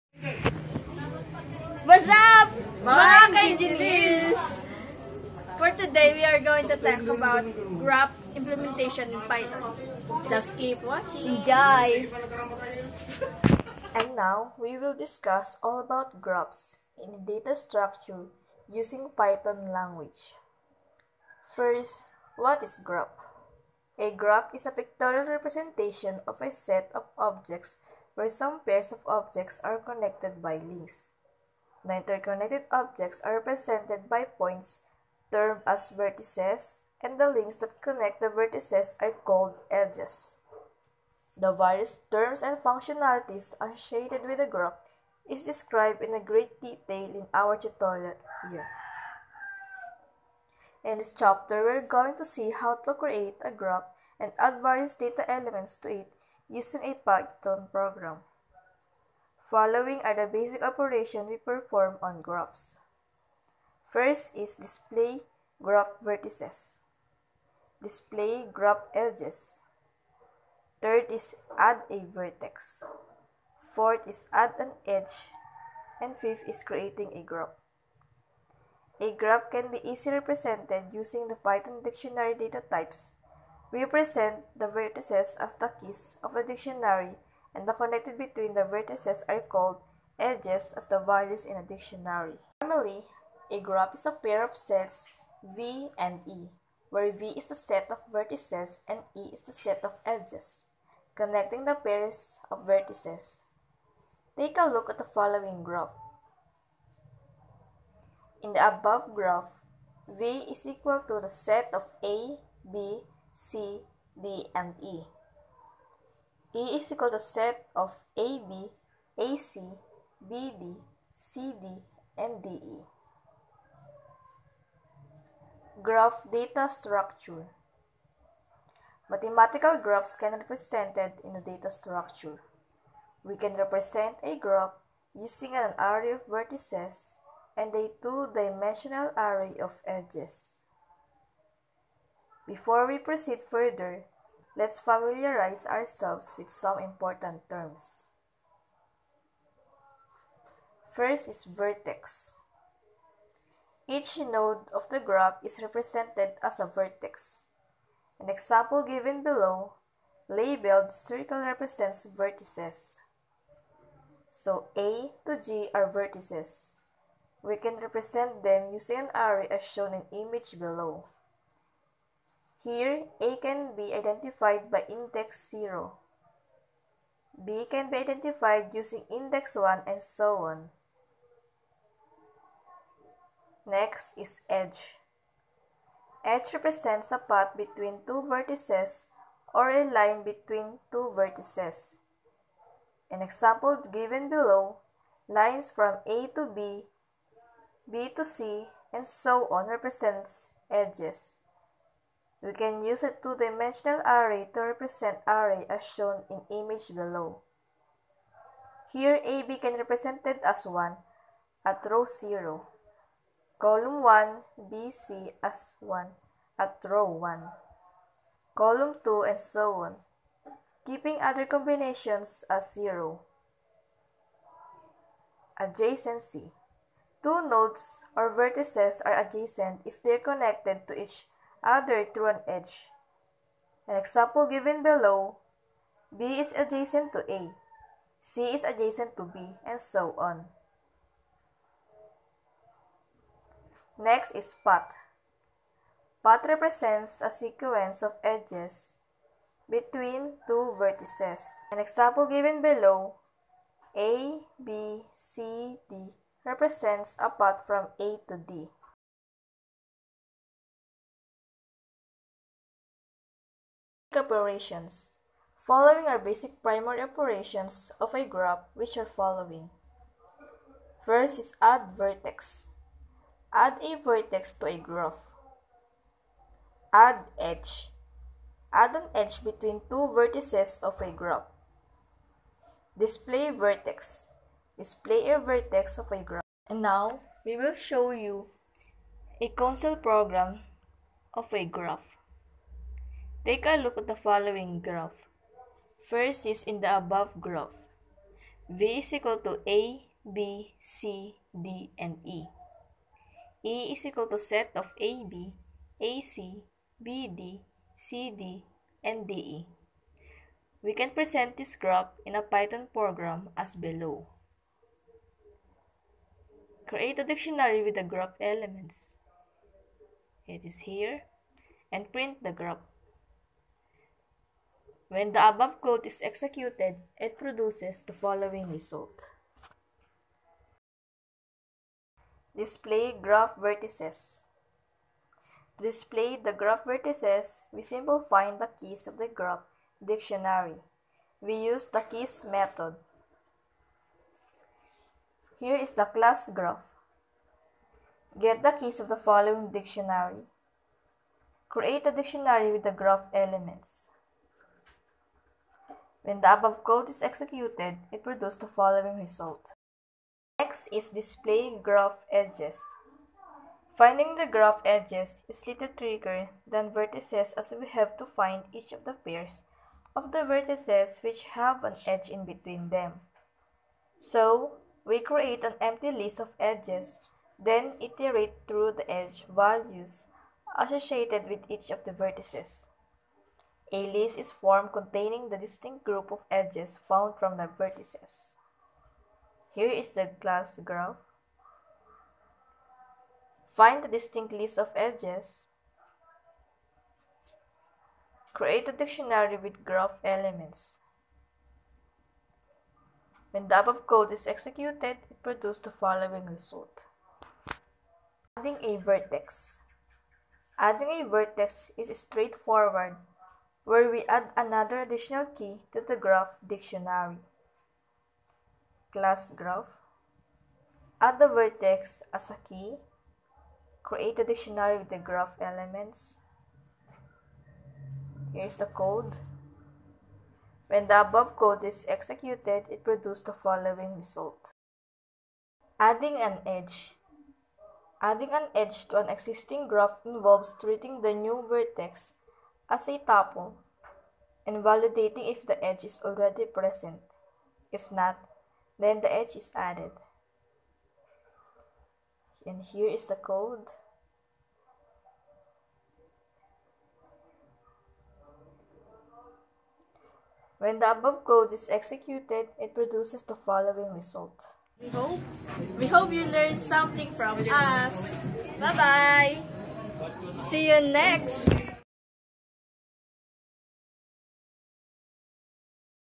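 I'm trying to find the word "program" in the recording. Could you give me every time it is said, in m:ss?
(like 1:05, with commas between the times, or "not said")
0:57, 4:49, 5:12.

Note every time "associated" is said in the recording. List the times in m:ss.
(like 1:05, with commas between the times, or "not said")
0:43, 6:20.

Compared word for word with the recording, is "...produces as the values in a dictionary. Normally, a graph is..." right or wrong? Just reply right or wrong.
wrong.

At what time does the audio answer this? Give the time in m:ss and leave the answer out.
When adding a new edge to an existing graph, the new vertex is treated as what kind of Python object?
7:23.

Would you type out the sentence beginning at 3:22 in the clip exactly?
We can use a two-dimensional array to represent array as shown in image below.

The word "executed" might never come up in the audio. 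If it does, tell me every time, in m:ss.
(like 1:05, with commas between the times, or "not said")
5:26, 5:57, 6:44, 7:12, 7:41.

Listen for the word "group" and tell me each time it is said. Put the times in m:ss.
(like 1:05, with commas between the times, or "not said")
6:26.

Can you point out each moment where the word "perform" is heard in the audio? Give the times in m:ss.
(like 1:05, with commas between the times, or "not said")
1:01.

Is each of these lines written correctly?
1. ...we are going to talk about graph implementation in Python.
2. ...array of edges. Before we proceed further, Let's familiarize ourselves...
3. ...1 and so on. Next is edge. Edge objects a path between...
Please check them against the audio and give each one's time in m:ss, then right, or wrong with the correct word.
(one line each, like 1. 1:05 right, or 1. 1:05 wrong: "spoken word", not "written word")
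1. 0:06 right
2. 2:19 right
3. 2:59 wrong: "represents", not "objects".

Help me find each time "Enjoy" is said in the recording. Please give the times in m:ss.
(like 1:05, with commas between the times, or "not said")
0:11.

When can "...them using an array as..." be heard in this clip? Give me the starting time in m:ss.
2:48.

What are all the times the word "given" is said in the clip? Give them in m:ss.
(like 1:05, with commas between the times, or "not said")
2:38, 3:13, 3:54, 4:12.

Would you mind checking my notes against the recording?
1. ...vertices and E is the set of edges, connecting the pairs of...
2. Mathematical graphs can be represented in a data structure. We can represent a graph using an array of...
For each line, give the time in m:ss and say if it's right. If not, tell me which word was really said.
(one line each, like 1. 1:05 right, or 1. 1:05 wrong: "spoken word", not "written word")
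1. 1:38 right
2. 2:09 right.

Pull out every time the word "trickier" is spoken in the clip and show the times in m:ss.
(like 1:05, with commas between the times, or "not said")
6:05.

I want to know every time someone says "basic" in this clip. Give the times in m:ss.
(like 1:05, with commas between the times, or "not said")
1:00, 4:26.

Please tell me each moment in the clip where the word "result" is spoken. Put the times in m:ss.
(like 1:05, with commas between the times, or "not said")
5:28, 5:59, 6:46, 7:14, 7:44.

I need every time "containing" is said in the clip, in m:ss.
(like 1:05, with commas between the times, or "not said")
6:24.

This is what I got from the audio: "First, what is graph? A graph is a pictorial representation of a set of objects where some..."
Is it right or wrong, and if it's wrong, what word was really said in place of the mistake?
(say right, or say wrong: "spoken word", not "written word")
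right.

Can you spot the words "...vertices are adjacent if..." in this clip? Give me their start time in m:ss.
3:48.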